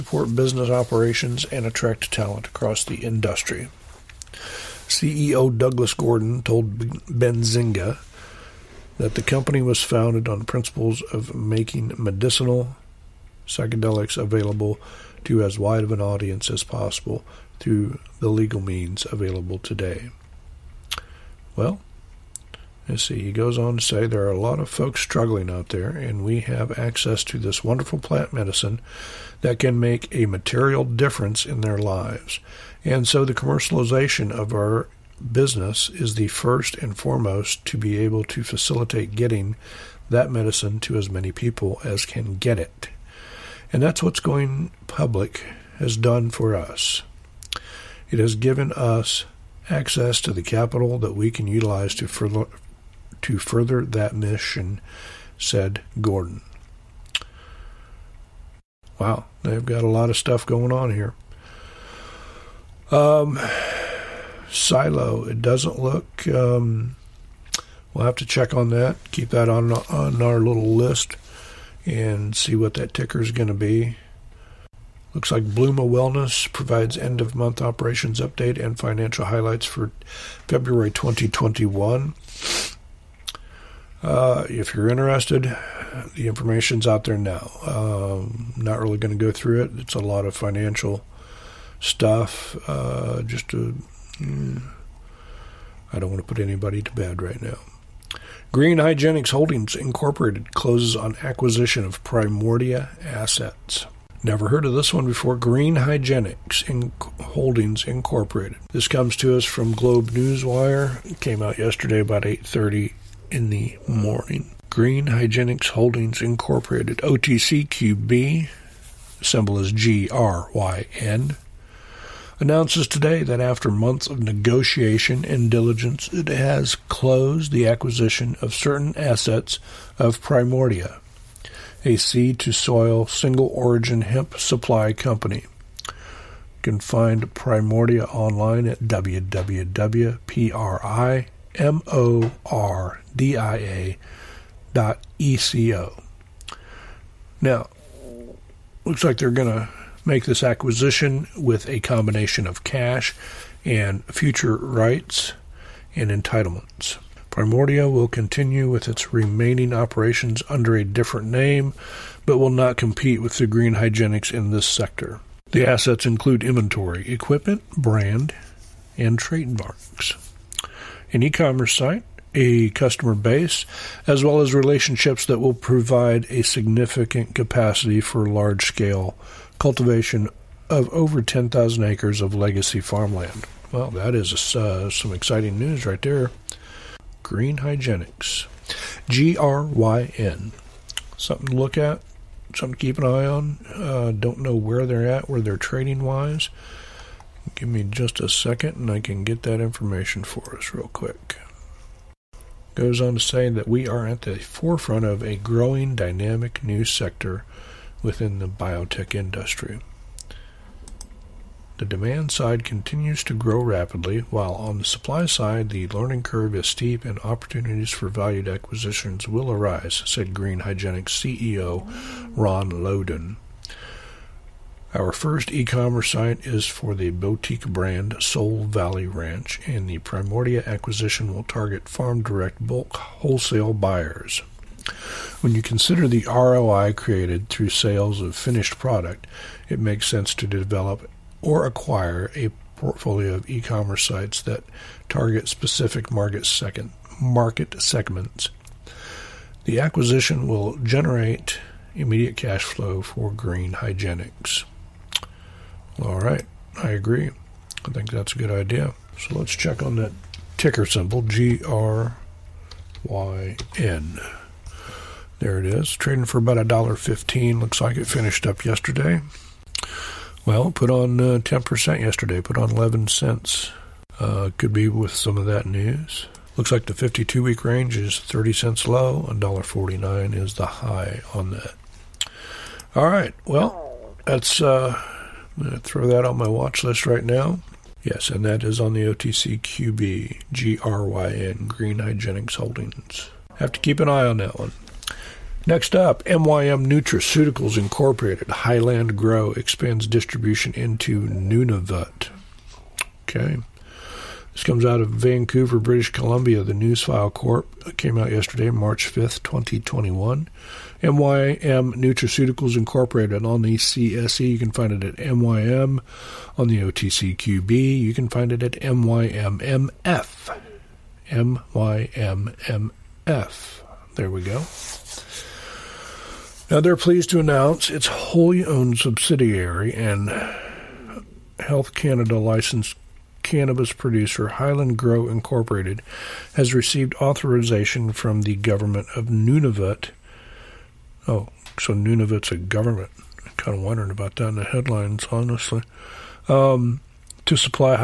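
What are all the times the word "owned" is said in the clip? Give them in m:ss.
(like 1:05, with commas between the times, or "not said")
5:28.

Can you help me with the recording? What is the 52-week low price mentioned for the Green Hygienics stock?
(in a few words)
30 cents.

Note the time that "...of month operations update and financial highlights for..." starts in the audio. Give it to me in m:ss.
1:17.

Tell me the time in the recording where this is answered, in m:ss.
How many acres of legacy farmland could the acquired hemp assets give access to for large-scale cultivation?
3:01.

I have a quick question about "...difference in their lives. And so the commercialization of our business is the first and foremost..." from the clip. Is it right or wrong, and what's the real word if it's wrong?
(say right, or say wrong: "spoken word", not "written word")
right.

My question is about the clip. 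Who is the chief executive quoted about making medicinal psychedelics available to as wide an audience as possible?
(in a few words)
Douglas Gordon.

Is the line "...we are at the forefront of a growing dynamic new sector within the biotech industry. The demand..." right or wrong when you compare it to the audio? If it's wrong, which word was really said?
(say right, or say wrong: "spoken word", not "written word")
right.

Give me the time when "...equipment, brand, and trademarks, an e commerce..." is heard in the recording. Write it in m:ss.
2:47.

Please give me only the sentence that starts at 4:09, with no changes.
The acquisition will generate immediate cash flow for Green Hygienics.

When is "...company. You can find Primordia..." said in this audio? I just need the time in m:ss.
2:14.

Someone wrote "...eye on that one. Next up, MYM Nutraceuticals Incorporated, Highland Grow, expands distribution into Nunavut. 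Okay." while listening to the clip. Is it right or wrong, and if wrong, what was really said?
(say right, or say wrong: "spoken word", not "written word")
right.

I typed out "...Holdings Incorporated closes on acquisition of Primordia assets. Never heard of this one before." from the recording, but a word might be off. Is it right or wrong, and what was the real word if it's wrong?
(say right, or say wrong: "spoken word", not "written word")
right.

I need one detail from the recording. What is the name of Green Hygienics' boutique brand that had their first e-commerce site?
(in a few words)
Soul Valley Ranch.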